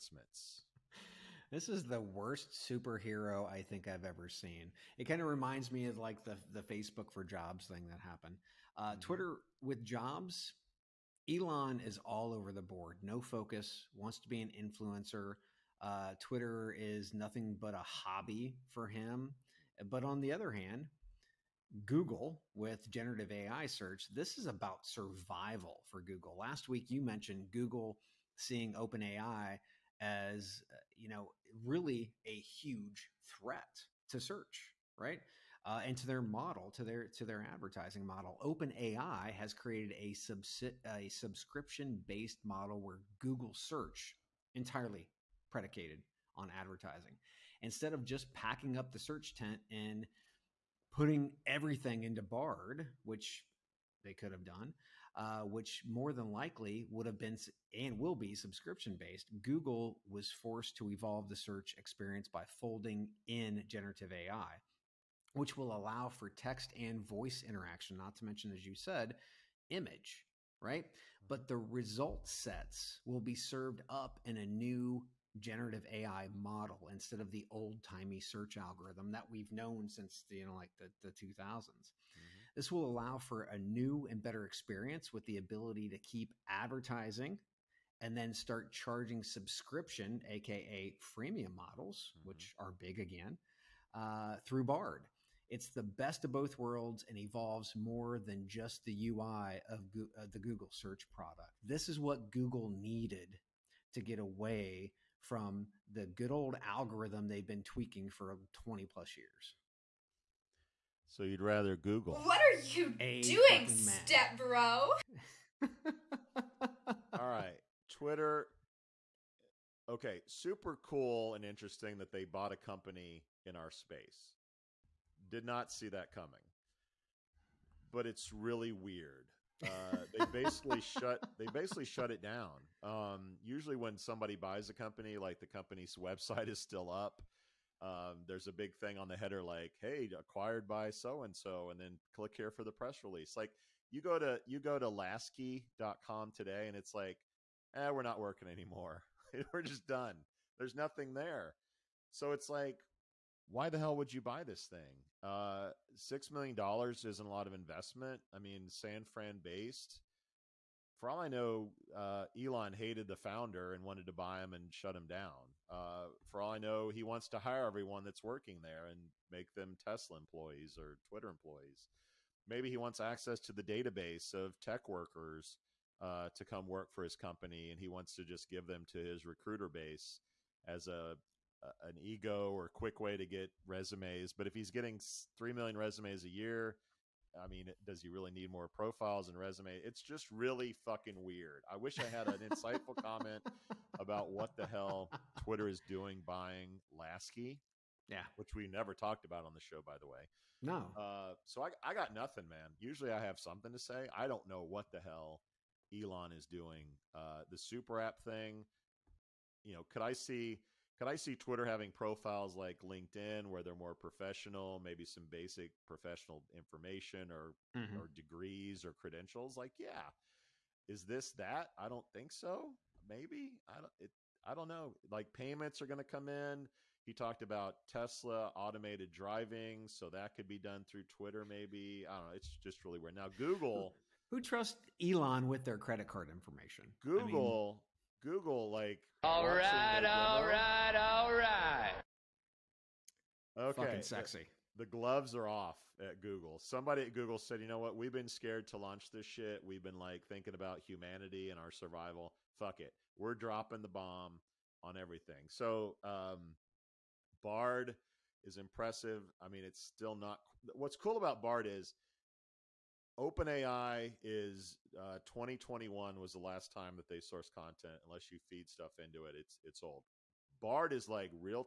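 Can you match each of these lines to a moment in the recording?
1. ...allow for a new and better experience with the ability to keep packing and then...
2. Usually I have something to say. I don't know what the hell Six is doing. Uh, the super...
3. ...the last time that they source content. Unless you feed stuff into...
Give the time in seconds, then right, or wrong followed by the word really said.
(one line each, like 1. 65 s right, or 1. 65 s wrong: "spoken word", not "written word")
1. 82 s wrong: "advertising", not "packing"
2. 202 s wrong: "Elon", not "Six"
3. 266 s right.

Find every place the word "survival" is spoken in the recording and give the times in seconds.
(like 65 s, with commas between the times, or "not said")
24 s, 251 s.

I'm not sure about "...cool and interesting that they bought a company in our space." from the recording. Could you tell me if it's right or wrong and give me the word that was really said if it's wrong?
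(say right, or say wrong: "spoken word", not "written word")
right.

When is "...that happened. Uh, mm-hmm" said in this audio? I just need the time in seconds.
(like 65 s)
7 s.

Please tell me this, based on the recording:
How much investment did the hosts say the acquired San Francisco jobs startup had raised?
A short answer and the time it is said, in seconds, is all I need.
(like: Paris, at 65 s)
$6 million, at 155 s.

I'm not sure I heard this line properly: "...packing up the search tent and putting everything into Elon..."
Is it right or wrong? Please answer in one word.
wrong.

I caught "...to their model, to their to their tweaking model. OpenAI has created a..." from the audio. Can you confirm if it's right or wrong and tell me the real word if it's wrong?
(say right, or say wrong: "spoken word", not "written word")
wrong: "advertising", not "tweaking".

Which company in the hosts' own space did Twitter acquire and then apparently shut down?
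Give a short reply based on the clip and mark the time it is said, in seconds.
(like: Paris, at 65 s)
Laskie, at 144 s.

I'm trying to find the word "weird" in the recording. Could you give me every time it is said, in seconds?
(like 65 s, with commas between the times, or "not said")
128 s, 191 s, 232 s.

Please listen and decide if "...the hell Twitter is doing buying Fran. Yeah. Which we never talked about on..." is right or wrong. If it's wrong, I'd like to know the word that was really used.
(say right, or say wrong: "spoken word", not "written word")
wrong: "Laskie", not "Fran".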